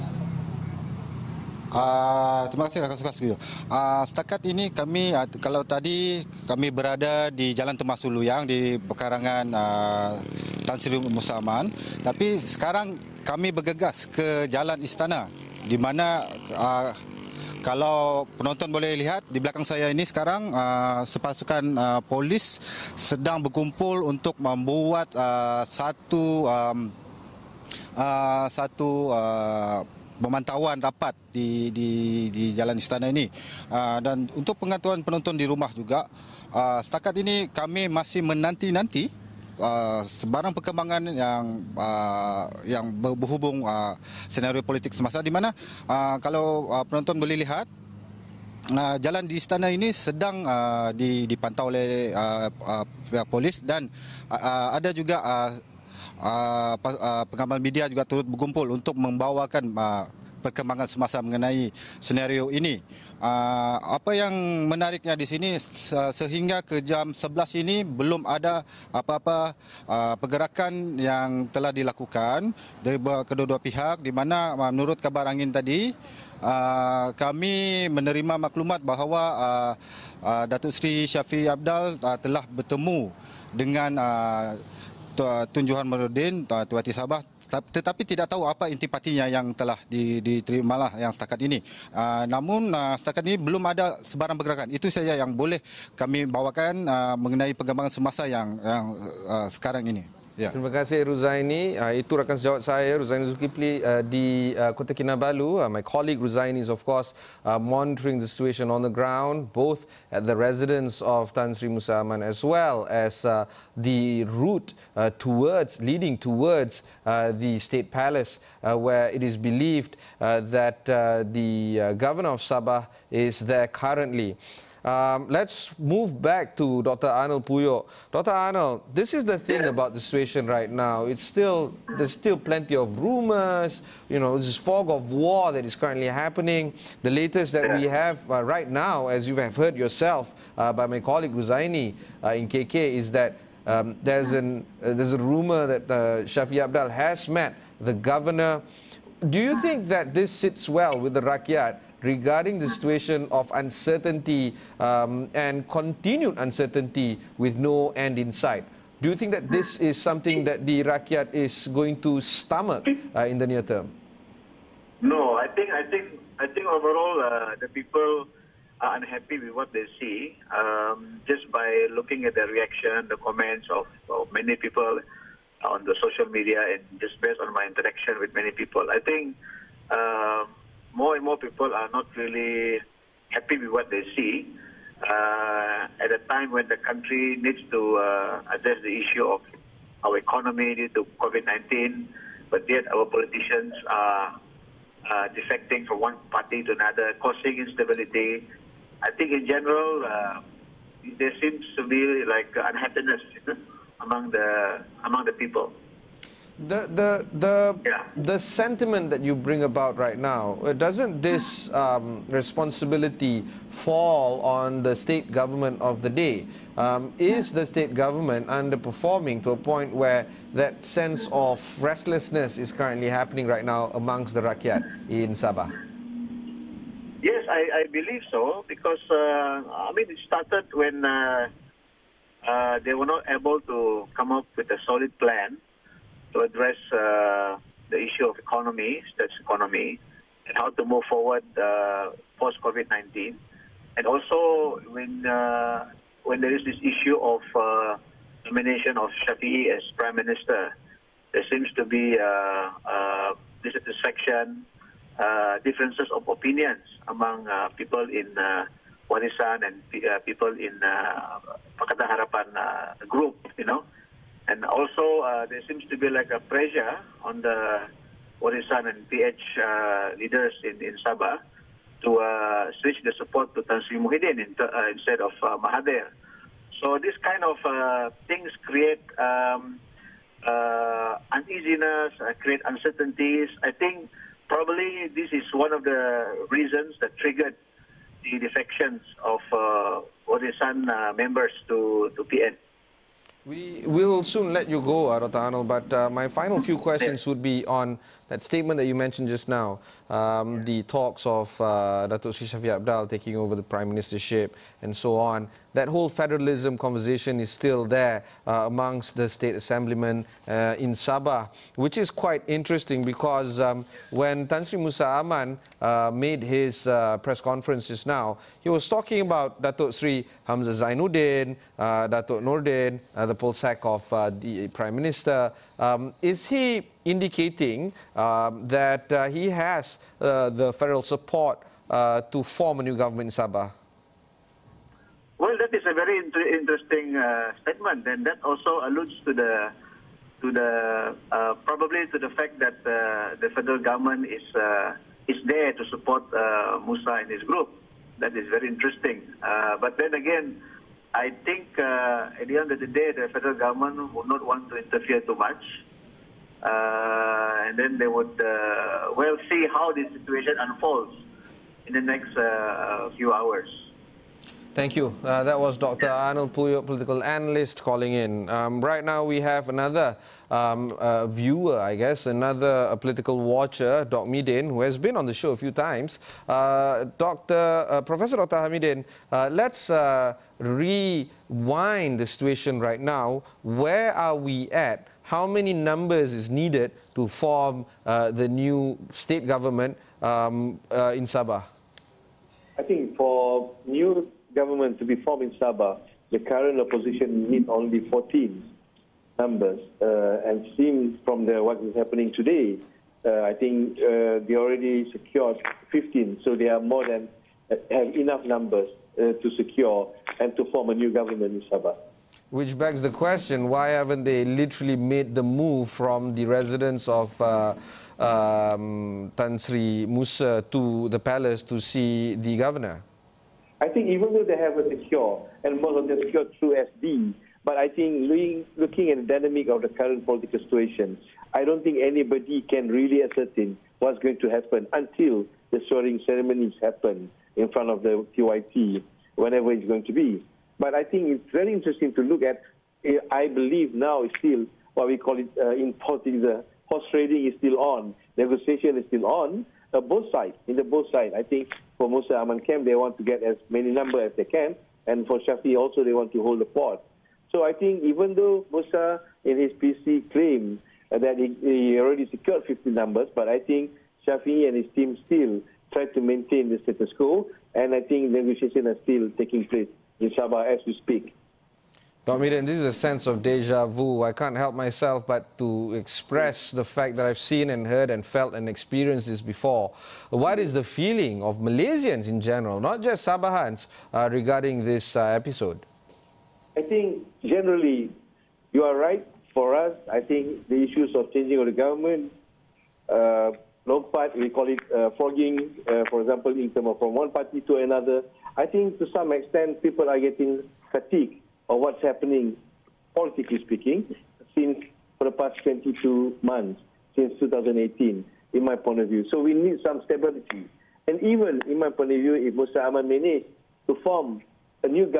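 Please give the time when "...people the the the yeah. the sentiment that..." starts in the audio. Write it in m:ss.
3:25.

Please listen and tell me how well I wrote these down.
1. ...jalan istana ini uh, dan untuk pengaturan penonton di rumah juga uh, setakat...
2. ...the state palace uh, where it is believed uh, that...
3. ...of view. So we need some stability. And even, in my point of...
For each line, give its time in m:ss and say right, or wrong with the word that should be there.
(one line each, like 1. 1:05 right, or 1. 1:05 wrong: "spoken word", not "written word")
1. 0:32 right
2. 1:57 right
3. 8:28 right.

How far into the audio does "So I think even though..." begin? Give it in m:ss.
7:37.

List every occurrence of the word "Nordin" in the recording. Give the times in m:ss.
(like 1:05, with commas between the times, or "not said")
5:22.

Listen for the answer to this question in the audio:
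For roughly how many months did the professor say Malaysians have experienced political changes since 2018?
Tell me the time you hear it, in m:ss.
8:25.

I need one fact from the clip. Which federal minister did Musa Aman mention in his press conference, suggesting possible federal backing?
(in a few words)
Hamzah Zainuddin.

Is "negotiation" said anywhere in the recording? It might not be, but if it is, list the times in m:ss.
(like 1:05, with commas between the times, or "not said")
7:28, 7:48.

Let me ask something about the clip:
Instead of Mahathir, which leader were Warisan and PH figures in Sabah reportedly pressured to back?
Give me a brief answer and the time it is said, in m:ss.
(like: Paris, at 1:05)
Muhyiddin, at 4:33.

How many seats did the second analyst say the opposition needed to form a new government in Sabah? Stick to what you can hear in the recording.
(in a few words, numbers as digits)
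14.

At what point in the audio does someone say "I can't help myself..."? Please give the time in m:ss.
7:54.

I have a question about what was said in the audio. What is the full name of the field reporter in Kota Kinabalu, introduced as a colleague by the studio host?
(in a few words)
Ruzaini Zulkifli.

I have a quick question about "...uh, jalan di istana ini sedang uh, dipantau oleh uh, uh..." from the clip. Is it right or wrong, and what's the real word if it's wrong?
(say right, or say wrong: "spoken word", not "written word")
right.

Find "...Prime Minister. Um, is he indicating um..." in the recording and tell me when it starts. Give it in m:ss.
5:24.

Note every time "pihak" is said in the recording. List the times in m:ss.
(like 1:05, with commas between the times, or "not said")
0:53, 1:13.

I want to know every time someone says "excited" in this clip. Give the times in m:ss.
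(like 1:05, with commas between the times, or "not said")
not said.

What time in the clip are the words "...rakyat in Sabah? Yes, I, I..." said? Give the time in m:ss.
3:44.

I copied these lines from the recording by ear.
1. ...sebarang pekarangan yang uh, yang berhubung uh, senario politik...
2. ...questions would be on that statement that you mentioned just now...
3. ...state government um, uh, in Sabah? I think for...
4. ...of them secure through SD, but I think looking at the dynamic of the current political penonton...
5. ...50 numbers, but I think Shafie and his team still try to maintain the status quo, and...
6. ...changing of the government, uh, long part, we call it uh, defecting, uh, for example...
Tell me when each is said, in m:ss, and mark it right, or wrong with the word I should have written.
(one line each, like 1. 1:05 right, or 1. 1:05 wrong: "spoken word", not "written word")
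1. 0:40 wrong: "perkembangan", not "pekarangan"
2. 4:56 right
3. 6:29 right
4. 7:05 wrong: "situation", not "penonton"
5. 7:42 right
6. 8:11 wrong: "fogging", not "defecting".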